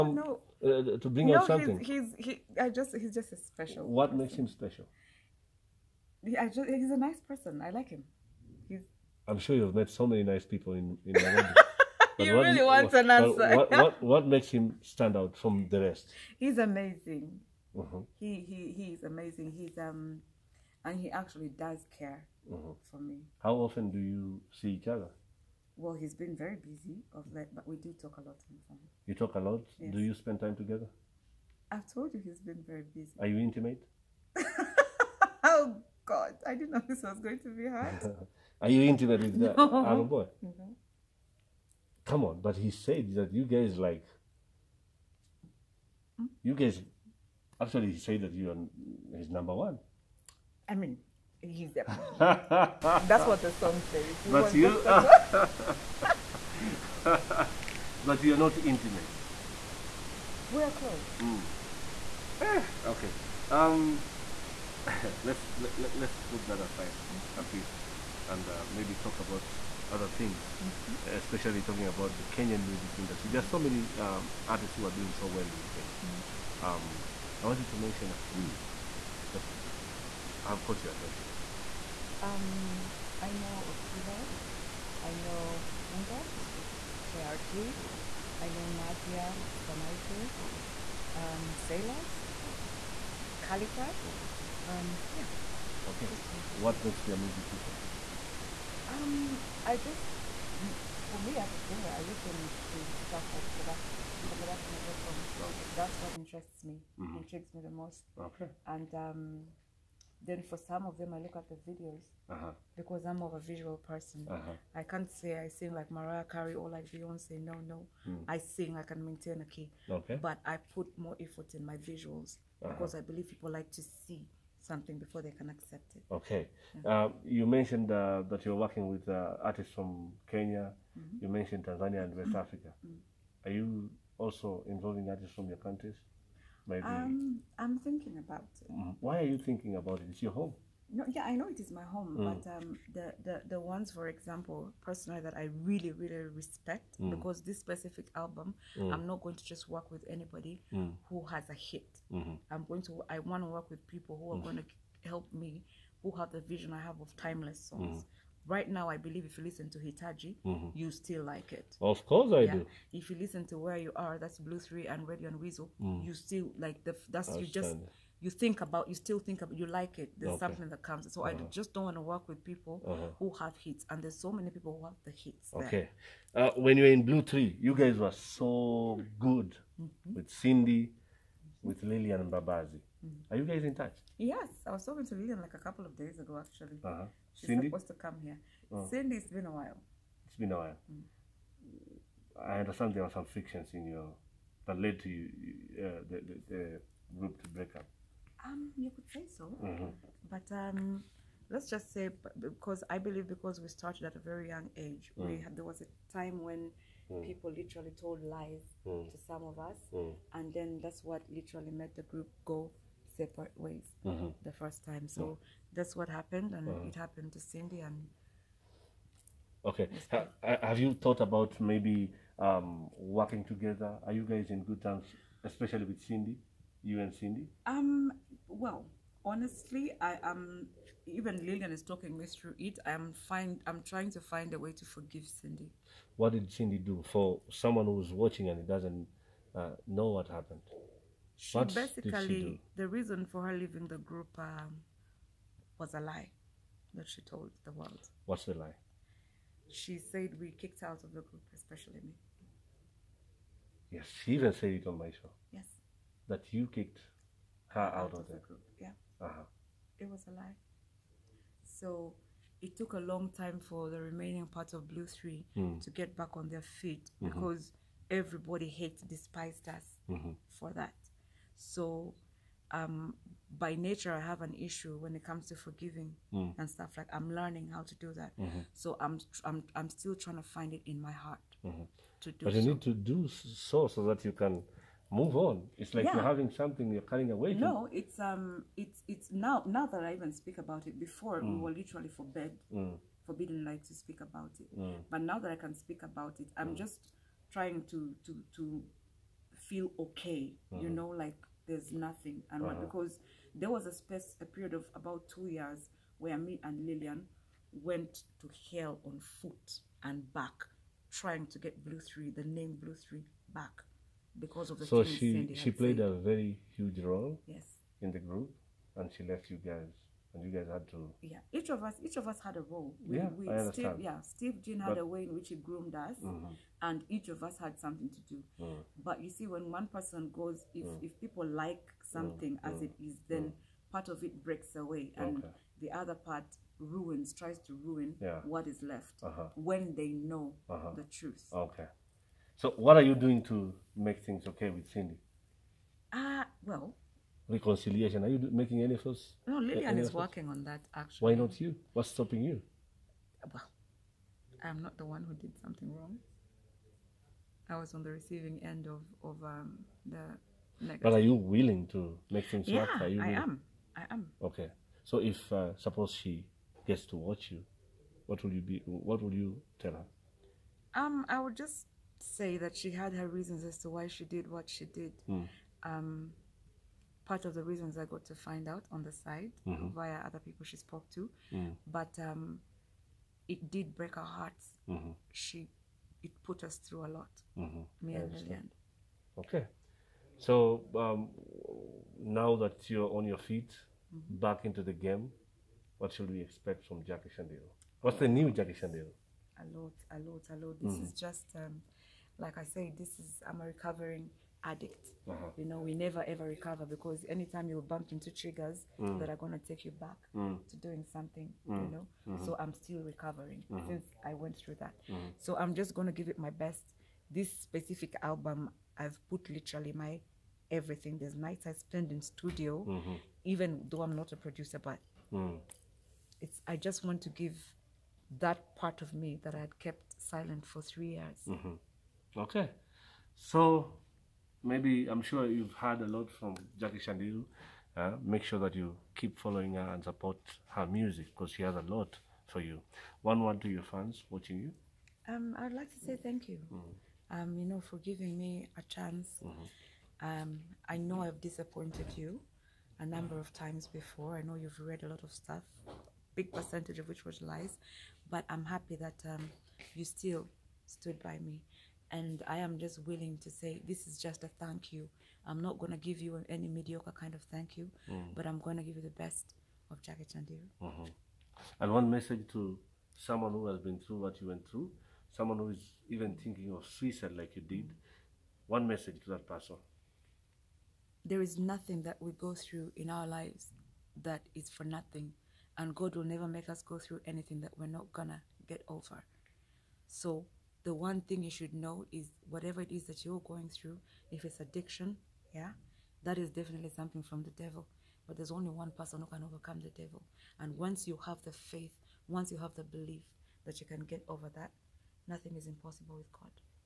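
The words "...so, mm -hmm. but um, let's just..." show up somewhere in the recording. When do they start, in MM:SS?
03:19.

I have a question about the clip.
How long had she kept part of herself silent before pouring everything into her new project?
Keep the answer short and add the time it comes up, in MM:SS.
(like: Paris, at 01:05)
3 years, at 07:10.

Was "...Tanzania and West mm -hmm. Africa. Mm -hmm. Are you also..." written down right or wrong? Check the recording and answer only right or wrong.
right.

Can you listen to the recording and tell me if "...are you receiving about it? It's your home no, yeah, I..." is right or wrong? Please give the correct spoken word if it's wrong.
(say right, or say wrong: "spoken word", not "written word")
wrong: "thinking", not "receiving".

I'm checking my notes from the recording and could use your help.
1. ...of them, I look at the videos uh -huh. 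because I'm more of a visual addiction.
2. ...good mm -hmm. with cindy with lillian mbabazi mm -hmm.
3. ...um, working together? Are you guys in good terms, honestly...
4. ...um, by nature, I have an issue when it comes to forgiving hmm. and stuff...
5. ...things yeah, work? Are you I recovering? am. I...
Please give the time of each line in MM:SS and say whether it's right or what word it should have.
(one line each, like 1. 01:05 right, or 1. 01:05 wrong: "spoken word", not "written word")
1. 01:50 wrong: "person", not "addiction"
2. 02:59 right
3. 03:42 wrong: "especially", not "honestly"
4. 04:32 right
5. 06:02 wrong: "willing", not "recovering".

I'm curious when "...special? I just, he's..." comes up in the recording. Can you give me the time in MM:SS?
00:04.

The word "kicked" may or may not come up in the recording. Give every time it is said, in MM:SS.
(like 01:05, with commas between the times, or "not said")
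04:10, 04:16.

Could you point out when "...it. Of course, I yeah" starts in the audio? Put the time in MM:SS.
02:41.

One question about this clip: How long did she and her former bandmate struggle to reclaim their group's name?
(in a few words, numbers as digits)
2 years.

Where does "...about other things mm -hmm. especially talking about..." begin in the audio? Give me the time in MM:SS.
01:09.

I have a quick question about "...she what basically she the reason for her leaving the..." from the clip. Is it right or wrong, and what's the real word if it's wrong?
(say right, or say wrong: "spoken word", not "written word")
right.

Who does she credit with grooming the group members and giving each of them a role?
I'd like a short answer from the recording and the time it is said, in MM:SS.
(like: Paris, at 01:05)
Steve Jean, at 05:24.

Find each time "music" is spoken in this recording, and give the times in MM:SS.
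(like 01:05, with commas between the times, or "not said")
01:12, 01:37, 07:20.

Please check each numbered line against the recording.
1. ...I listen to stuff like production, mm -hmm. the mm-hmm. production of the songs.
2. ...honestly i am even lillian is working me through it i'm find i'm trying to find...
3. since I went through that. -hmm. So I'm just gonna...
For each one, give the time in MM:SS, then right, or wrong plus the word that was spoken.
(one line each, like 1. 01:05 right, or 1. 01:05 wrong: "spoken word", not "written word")
1. 01:41 right
2. 03:49 wrong: "talking", not "working"
3. 06:53 right.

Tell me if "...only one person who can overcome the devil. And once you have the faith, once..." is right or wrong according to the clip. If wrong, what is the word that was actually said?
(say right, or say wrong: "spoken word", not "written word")
right.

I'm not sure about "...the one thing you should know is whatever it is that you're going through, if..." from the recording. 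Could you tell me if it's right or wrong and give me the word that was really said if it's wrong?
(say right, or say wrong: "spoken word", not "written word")
right.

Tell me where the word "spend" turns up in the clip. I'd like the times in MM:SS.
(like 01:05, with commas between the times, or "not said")
00:30, 07:01.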